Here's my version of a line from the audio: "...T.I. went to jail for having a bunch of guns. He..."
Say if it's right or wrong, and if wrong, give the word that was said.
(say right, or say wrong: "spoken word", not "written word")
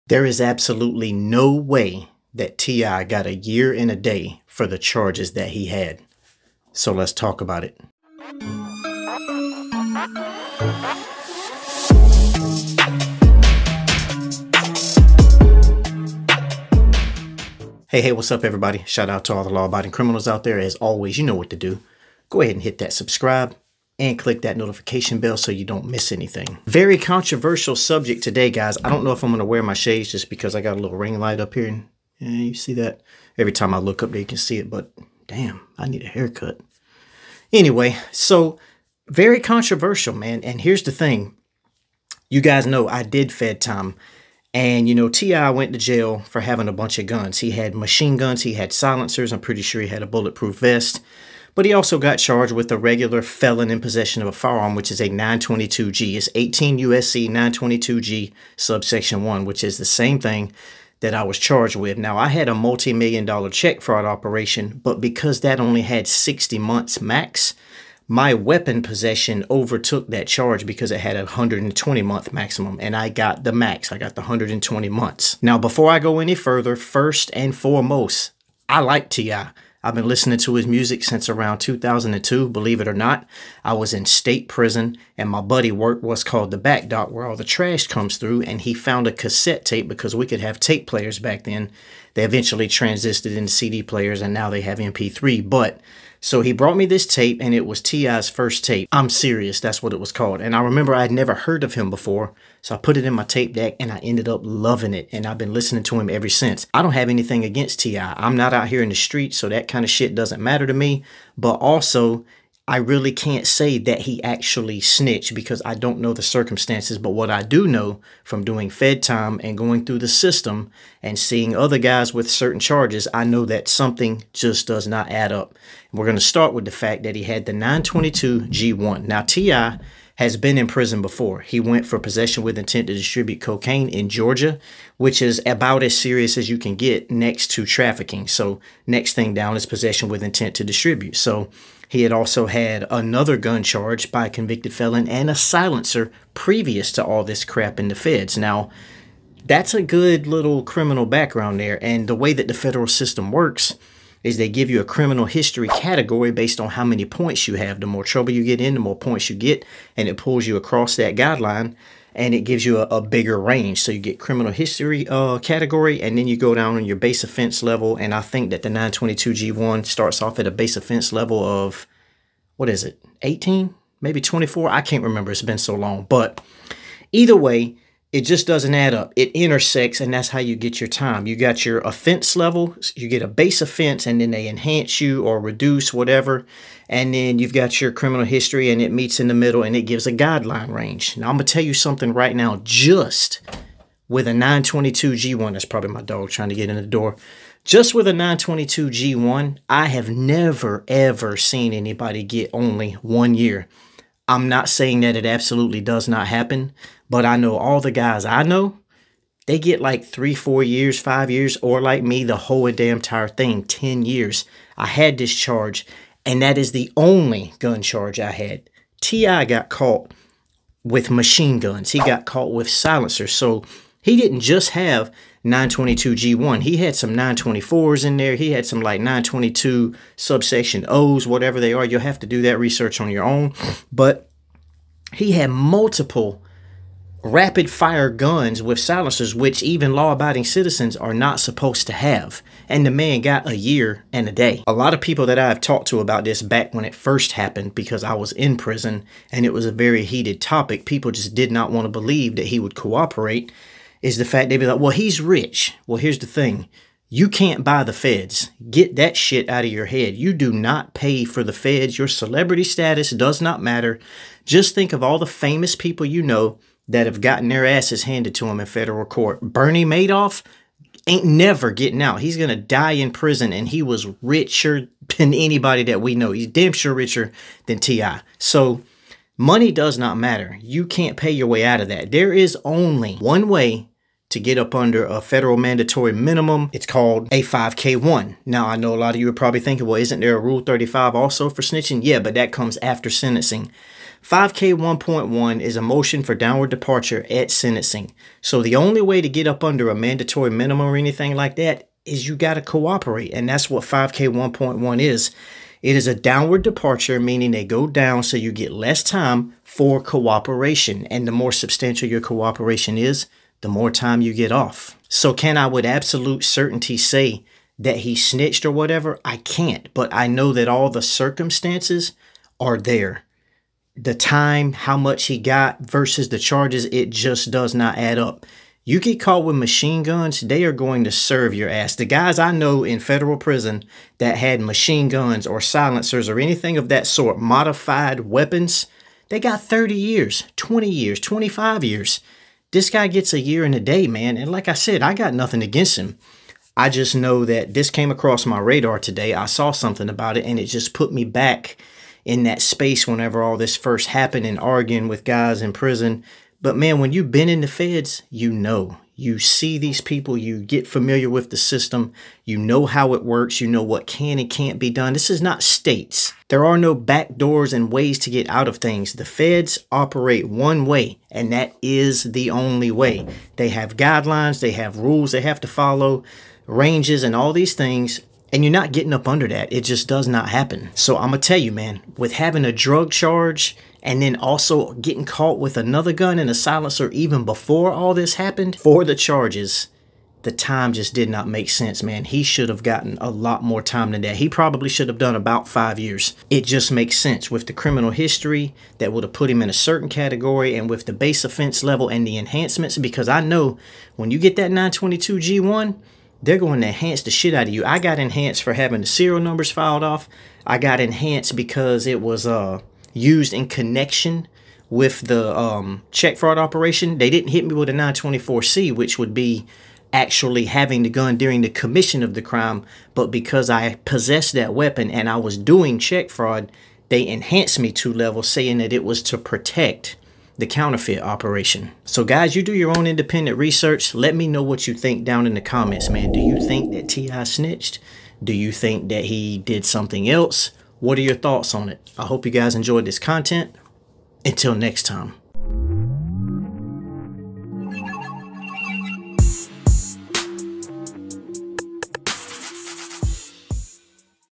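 right.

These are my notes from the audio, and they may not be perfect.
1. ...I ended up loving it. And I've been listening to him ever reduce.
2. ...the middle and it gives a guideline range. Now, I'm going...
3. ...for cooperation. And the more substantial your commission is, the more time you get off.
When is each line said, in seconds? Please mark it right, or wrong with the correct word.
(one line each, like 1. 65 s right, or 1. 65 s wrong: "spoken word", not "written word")
1. 103 s wrong: "since", not "reduce"
2. 189 s right
3. 309 s wrong: "cooperation", not "commission".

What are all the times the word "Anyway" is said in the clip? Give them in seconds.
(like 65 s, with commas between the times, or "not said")
37 s.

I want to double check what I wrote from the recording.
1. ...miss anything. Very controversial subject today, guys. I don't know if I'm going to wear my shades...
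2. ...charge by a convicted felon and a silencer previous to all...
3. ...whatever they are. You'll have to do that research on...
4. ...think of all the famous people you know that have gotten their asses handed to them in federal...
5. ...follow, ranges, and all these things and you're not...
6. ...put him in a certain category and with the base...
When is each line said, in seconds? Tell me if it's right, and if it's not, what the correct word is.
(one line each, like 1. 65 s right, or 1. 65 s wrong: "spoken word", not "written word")
1. 25 s right
2. 143 s right
3. 231 s right
4. 264 s right
5. 375 s right
6. 399 s right.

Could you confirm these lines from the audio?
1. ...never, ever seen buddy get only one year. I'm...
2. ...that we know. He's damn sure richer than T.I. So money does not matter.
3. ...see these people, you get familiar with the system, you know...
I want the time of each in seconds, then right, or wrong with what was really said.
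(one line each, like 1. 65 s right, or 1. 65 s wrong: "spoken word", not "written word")
1. 200 s wrong: "anybody", not "buddy"
2. 275 s right
3. 359 s right.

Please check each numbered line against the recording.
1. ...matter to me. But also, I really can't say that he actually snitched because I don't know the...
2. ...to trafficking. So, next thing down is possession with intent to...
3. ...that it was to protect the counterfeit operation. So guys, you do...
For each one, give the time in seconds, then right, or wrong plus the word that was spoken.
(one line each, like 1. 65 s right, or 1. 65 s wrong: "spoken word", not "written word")
1. 110 s right
2. 137 s right
3. 428 s right.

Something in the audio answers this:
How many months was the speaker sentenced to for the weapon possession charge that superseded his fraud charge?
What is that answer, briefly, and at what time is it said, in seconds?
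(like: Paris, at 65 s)
120 months, at 74 s.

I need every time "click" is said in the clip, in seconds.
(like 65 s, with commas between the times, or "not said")
24 s.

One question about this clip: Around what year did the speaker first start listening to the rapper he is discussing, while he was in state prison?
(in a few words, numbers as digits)
2002.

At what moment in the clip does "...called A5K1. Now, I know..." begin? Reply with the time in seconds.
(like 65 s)
286 s.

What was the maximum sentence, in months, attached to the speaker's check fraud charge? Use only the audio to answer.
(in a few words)
60 months.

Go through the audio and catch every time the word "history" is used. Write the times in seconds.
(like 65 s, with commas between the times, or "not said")
155 s, 164 s, 188 s, 398 s.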